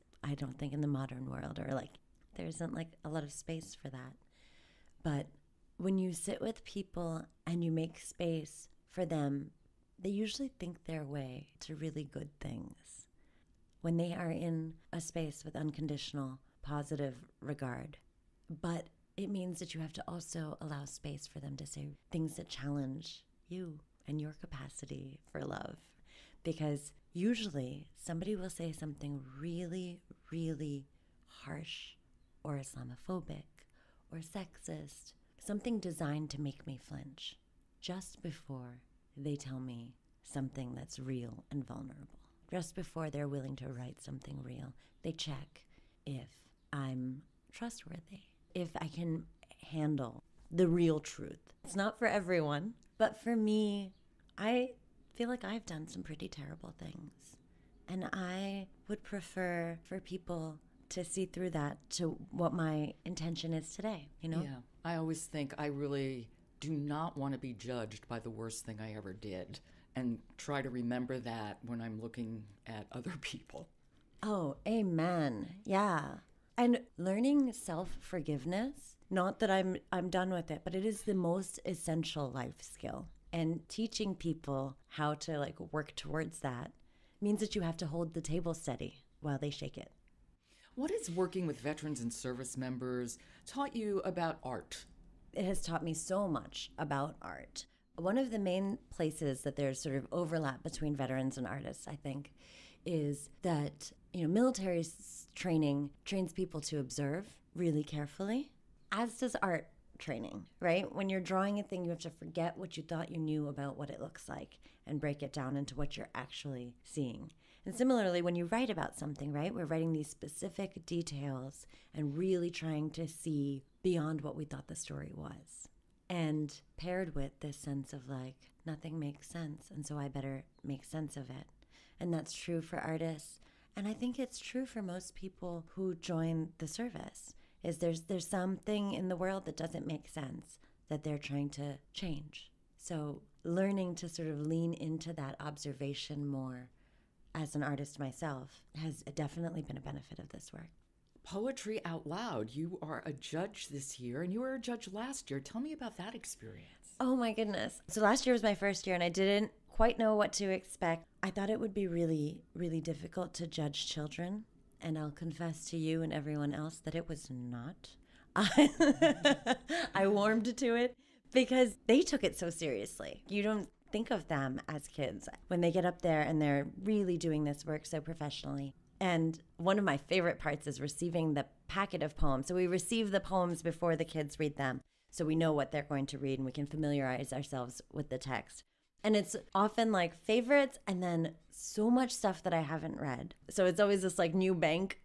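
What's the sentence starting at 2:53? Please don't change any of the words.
You don't think of them as kids when they get up there and they're really doing this work so professionally.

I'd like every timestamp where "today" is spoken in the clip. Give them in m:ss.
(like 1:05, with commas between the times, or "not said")
1:03.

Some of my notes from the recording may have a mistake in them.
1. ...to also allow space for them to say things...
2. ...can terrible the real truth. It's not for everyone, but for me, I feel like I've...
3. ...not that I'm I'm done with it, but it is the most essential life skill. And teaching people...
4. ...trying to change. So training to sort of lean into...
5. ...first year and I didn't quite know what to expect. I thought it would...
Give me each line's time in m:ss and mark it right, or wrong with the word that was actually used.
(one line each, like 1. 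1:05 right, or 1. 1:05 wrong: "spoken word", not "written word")
1. 0:19 right
2. 0:48 wrong: "handle", not "terrible"
3. 1:19 right
4. 2:21 wrong: "learning", not "training"
5. 2:38 right.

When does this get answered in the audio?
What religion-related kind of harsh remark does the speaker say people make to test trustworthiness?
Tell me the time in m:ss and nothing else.
0:32.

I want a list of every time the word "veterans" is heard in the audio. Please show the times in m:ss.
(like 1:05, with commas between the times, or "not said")
1:31, 1:40.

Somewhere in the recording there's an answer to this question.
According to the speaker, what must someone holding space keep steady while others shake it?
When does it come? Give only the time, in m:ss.
1:28.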